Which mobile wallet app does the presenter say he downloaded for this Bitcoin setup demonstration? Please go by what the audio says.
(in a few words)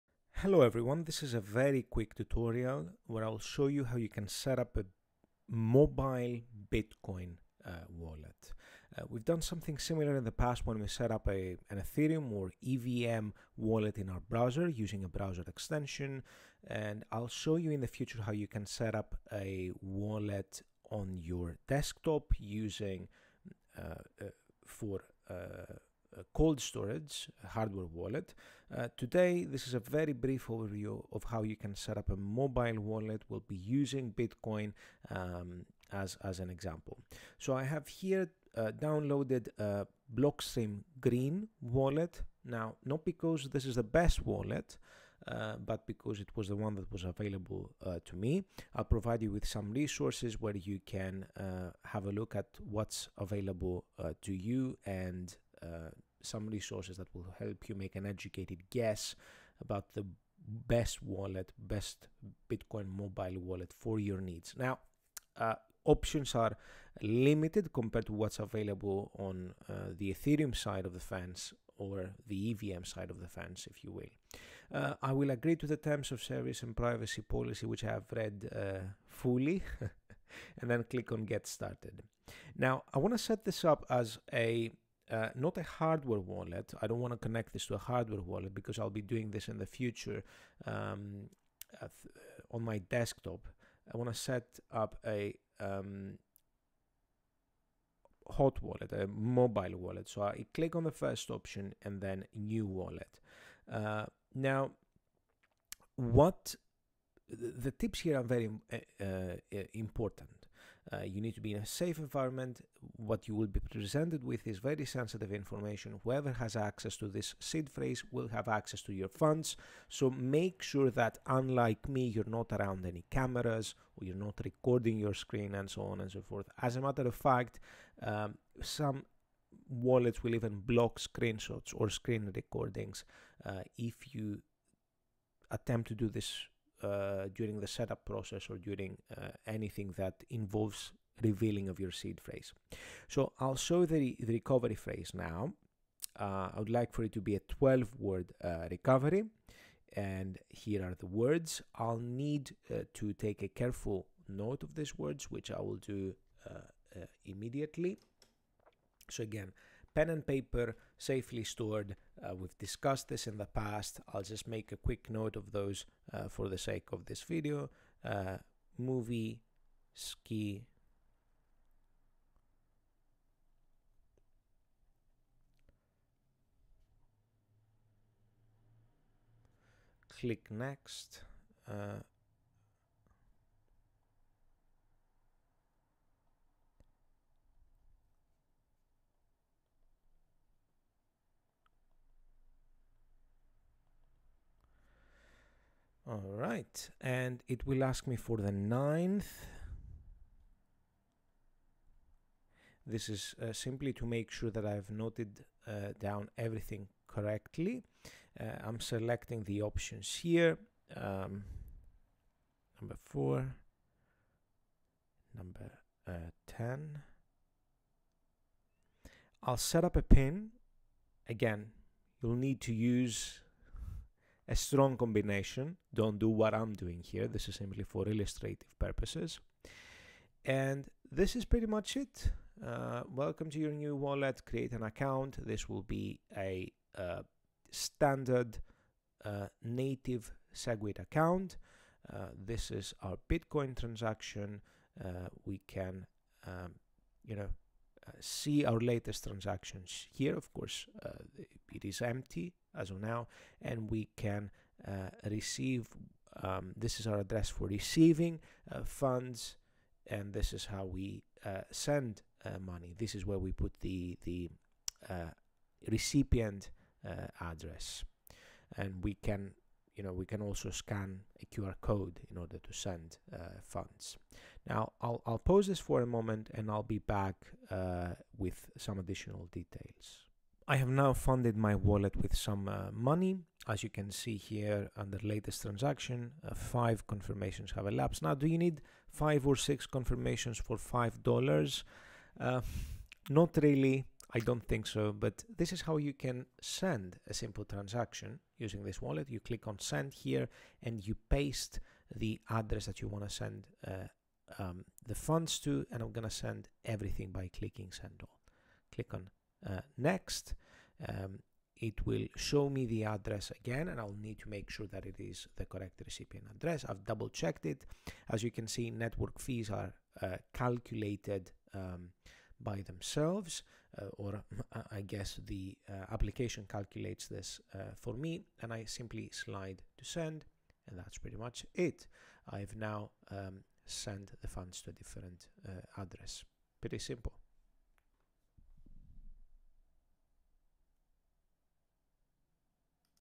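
Blockstream Green.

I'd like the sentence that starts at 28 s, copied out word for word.
Uh, today, this is a very brief overview of how you can set up a mobile wallet.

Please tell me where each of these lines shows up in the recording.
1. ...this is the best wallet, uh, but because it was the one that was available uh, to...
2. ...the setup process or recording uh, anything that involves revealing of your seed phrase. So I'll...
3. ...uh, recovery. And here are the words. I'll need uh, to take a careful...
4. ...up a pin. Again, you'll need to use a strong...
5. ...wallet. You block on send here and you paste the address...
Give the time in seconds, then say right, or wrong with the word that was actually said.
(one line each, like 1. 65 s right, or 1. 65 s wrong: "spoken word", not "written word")
1. 43 s right
2. 137 s wrong: "during", not "recording"
3. 148 s right
4. 219 s right
5. 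299 s wrong: "click", not "block".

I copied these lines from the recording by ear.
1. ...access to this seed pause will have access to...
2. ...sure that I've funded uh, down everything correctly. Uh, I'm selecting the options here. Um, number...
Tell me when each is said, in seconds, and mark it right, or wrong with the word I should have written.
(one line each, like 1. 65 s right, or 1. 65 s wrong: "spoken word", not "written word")
1. 116 s wrong: "phrase", not "pause"
2. 204 s wrong: "noted", not "funded".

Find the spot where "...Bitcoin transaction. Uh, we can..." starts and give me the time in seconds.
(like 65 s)
243 s.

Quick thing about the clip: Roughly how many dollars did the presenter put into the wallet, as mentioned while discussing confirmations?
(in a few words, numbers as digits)
$5.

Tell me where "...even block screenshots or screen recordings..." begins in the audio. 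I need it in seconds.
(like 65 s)
130 s.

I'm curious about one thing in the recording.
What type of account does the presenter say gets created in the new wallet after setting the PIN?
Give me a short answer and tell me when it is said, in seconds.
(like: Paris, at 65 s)
native SegWit, at 239 s.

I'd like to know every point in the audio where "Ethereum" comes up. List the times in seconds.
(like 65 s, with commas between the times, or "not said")
11 s, 70 s.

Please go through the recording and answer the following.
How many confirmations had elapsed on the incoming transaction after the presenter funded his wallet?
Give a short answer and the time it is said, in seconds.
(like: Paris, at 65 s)
5, at 286 s.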